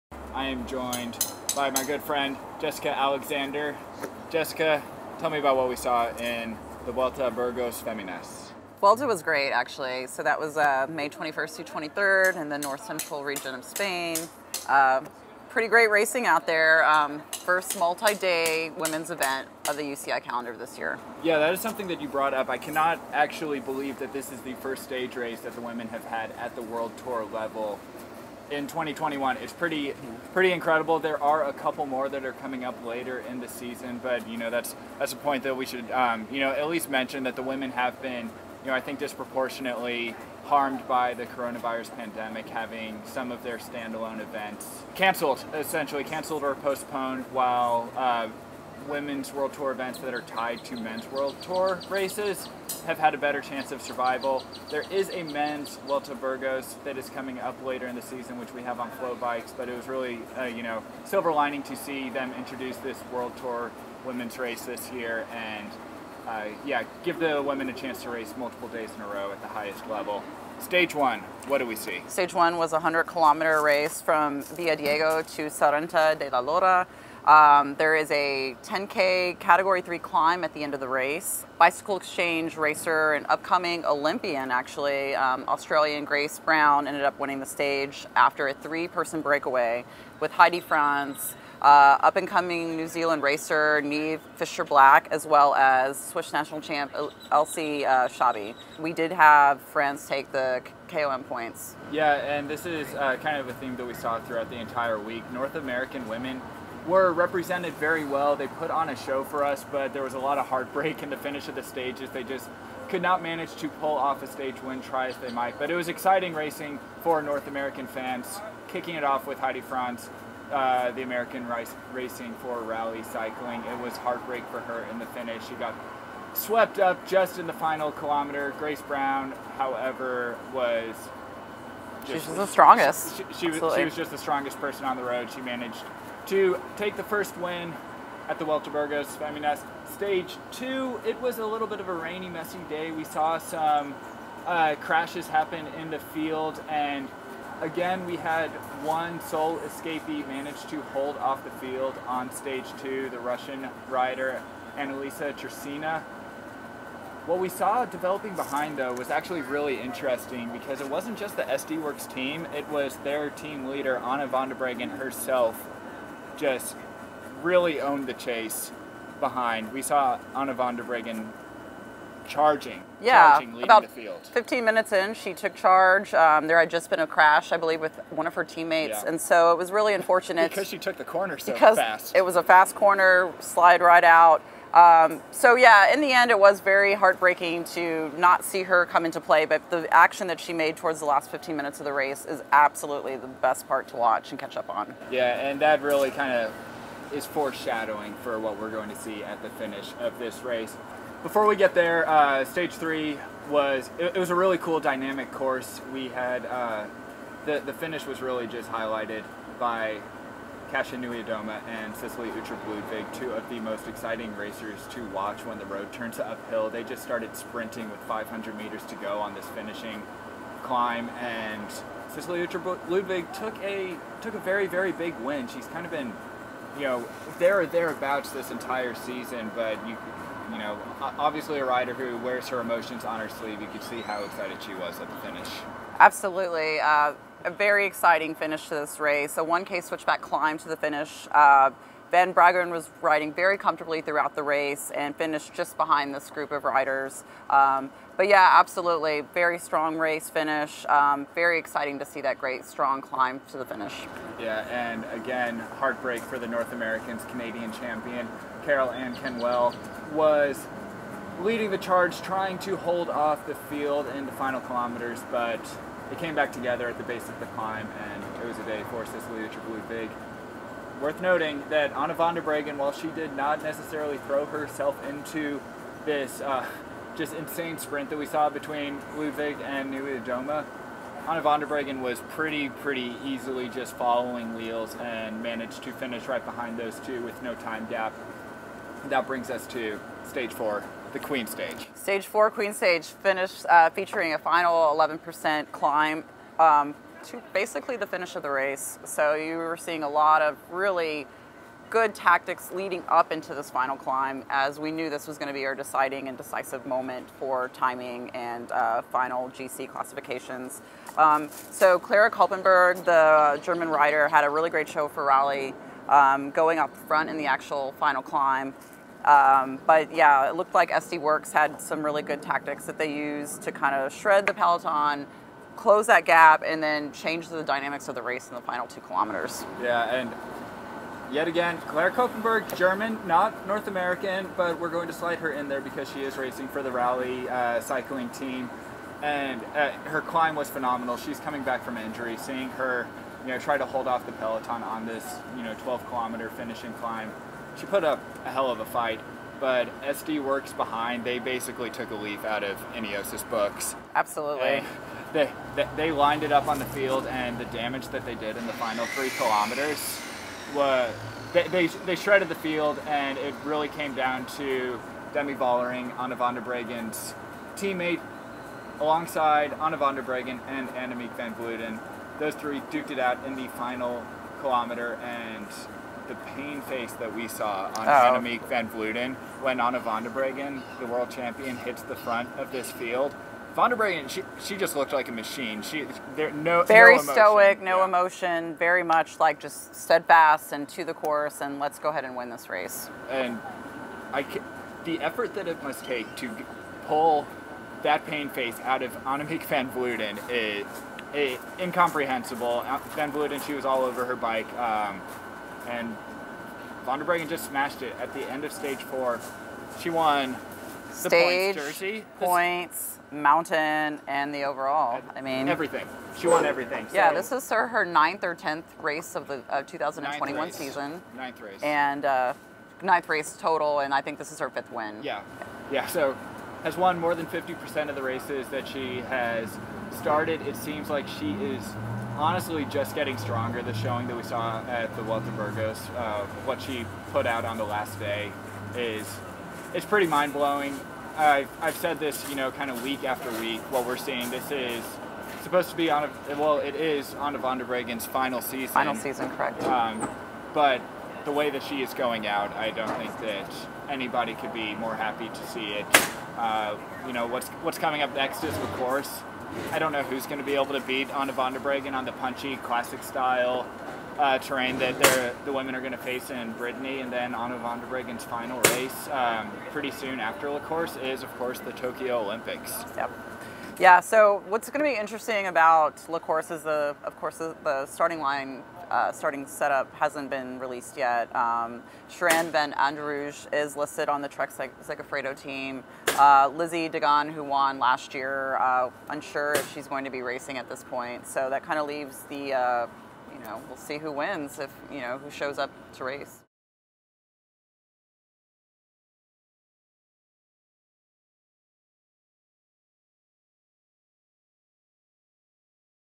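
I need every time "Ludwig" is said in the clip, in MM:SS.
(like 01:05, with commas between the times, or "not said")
04:29, 04:39.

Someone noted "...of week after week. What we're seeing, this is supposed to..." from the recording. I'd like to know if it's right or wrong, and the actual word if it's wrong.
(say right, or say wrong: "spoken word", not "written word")
right.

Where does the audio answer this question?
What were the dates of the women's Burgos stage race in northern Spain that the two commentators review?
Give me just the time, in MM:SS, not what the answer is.
00:10.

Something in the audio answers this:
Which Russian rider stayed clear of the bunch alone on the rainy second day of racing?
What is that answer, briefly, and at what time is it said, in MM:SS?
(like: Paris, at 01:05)
Annalisa Tresina, at 02:34.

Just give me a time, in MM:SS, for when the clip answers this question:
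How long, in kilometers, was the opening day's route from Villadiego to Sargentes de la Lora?
01:12.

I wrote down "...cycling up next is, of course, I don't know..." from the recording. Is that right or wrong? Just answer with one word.
wrong.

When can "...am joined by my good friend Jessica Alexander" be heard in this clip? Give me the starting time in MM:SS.
00:00.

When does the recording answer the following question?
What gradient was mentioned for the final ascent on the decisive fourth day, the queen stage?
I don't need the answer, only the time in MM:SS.
04:54.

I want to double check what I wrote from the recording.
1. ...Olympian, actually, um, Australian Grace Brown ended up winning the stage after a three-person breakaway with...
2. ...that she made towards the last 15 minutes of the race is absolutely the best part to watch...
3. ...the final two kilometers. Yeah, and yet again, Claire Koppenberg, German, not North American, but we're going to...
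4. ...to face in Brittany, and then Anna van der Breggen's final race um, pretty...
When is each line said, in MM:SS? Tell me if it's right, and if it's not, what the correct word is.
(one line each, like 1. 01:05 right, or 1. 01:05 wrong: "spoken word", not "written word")
1. 01:23 right
2. 03:10 right
3. 05:28 right
4. 07:46 right.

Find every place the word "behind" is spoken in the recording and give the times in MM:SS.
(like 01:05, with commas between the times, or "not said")
02:38, 02:49, 04:05, 04:46, 05:50.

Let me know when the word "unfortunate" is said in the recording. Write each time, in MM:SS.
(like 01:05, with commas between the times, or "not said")
02:59.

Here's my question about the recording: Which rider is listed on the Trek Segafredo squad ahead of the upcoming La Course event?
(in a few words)
Shirin Van Anrooij.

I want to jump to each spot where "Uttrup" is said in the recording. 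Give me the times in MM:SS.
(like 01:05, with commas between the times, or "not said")
03:32, 03:42, 04:29.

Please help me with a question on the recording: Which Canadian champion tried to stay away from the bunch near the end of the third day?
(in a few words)
Karol-Ann Canuel.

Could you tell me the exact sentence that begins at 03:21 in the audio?
Before we get there, uh, stage three was it, it, was a really cool dynamic course.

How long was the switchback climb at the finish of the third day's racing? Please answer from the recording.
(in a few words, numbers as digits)
1K.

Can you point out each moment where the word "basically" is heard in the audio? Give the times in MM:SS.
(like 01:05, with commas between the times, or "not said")
04:57, 05:51.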